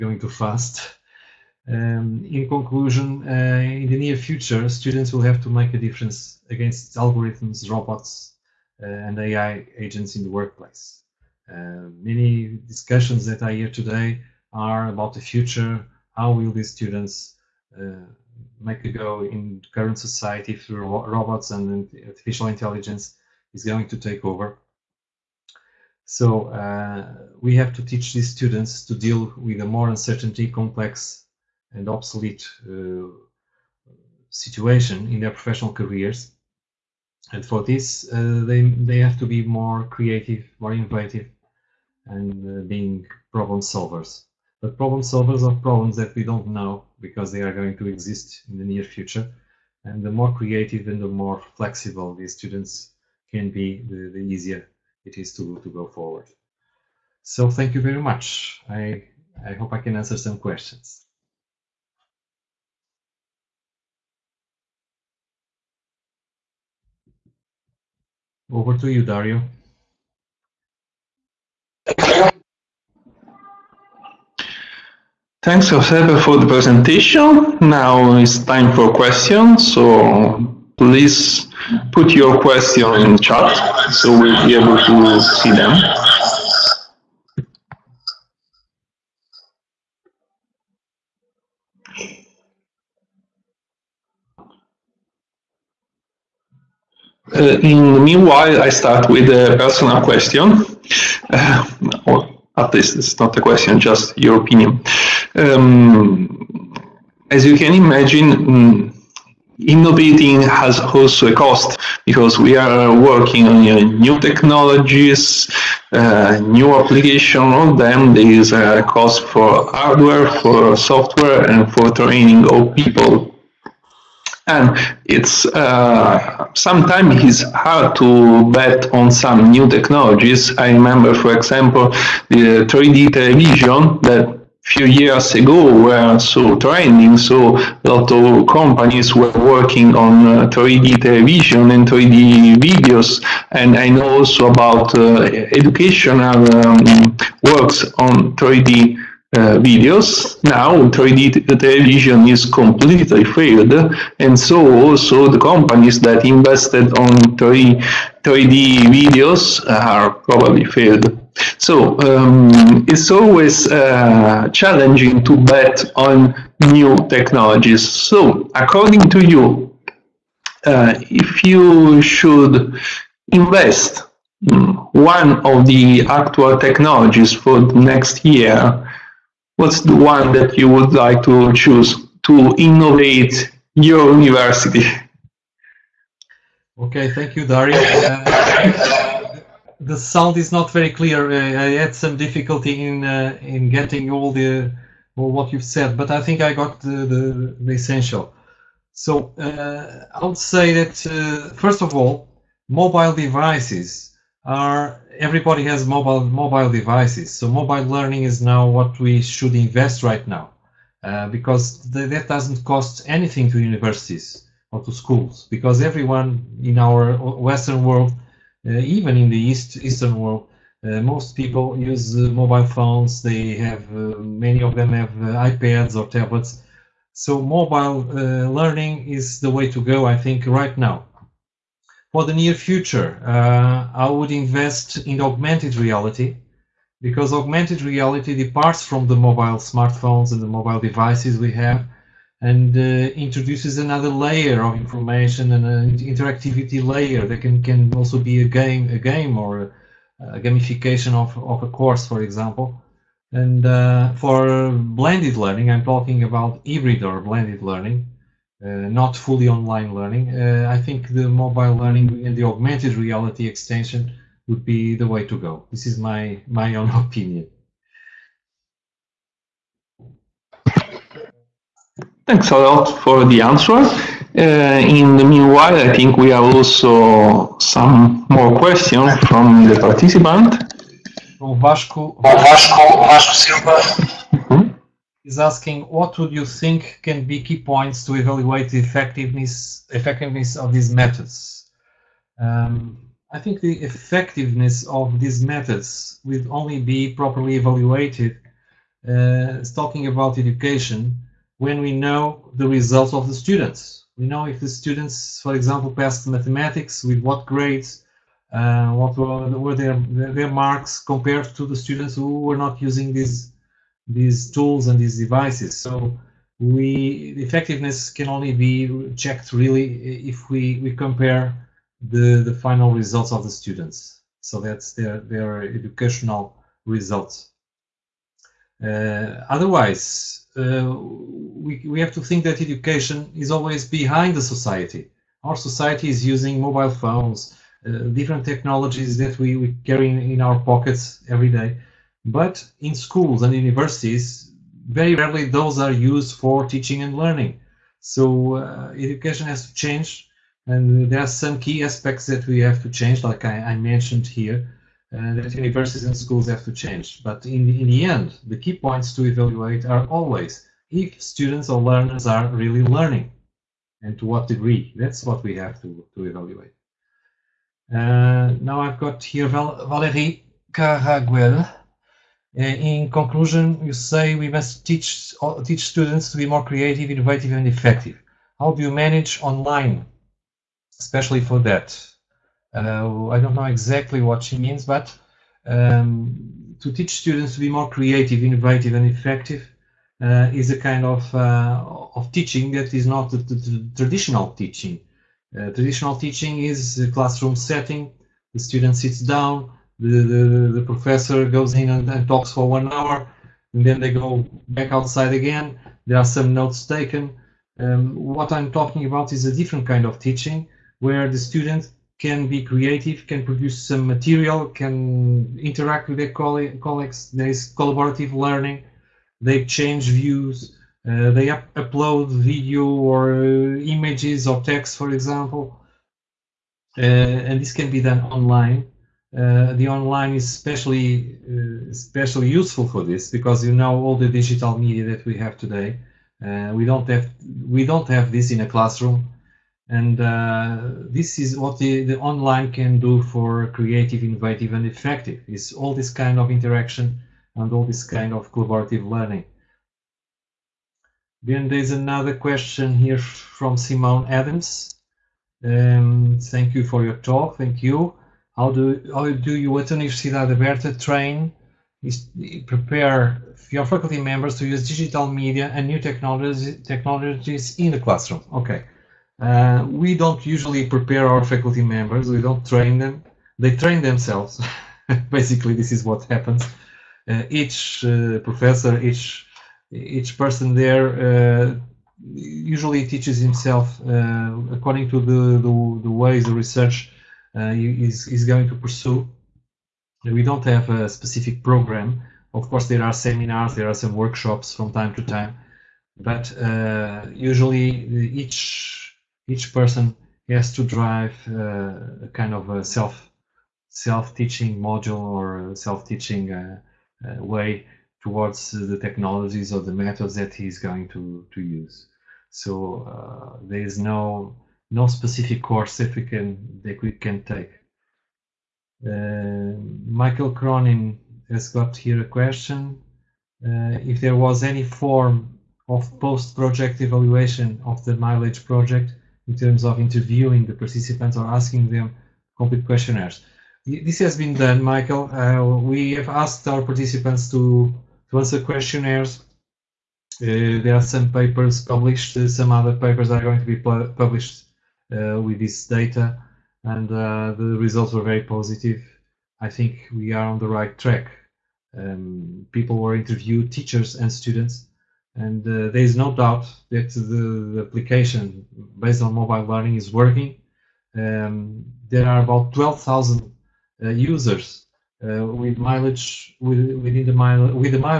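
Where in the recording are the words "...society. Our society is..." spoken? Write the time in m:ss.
5:34.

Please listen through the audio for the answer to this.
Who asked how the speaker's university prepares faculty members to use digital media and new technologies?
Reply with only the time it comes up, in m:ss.
7:33.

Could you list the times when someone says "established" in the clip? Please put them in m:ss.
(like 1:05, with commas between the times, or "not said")
not said.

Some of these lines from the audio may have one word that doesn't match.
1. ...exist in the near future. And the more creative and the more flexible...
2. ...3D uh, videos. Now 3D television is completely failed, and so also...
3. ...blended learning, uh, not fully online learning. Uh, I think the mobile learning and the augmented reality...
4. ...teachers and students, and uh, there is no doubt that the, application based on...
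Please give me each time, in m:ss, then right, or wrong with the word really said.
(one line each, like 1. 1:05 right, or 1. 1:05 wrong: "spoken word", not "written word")
1. 0:47 right
2. 2:28 right
3. 4:17 right
4. 9:13 right.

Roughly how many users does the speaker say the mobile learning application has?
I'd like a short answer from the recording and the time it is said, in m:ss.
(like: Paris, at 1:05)
12,000, at 9:22.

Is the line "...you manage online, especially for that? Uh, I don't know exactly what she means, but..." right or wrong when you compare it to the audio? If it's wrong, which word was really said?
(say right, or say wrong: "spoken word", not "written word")
right.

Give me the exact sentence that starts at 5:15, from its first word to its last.
So we the effectiveness can only be checked really if we, we compare the, the final results of the students.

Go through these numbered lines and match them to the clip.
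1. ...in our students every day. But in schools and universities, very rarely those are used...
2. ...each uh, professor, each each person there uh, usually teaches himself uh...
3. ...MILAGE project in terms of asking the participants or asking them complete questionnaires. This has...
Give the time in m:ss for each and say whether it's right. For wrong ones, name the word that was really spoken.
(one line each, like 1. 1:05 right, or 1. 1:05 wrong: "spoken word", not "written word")
1. 5:40 wrong: "pockets", not "students"
2. 7:57 right
3. 8:48 wrong: "interviewing", not "asking".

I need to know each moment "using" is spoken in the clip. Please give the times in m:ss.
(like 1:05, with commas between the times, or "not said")
5:12, 5:36.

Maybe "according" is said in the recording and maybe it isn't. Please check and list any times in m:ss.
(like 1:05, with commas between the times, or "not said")
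2:48, 8:04.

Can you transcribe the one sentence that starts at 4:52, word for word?
Um, I think the effectiveness of these methods will only be properly evaluated.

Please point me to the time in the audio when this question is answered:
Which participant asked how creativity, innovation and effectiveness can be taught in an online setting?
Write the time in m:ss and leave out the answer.
6:09.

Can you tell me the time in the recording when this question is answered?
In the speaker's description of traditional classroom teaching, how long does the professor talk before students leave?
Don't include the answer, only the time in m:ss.
6:42.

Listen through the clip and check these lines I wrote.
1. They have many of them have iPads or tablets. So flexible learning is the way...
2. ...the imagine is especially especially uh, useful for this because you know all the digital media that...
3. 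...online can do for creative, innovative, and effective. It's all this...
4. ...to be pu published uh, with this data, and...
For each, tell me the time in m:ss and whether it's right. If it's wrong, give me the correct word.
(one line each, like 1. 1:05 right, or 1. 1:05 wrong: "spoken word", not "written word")
1. 3:43 wrong: "mobile", not "flexible"
2. 7:09 wrong: "online", not "imagine"
3. 7:22 right
4. 9:03 right.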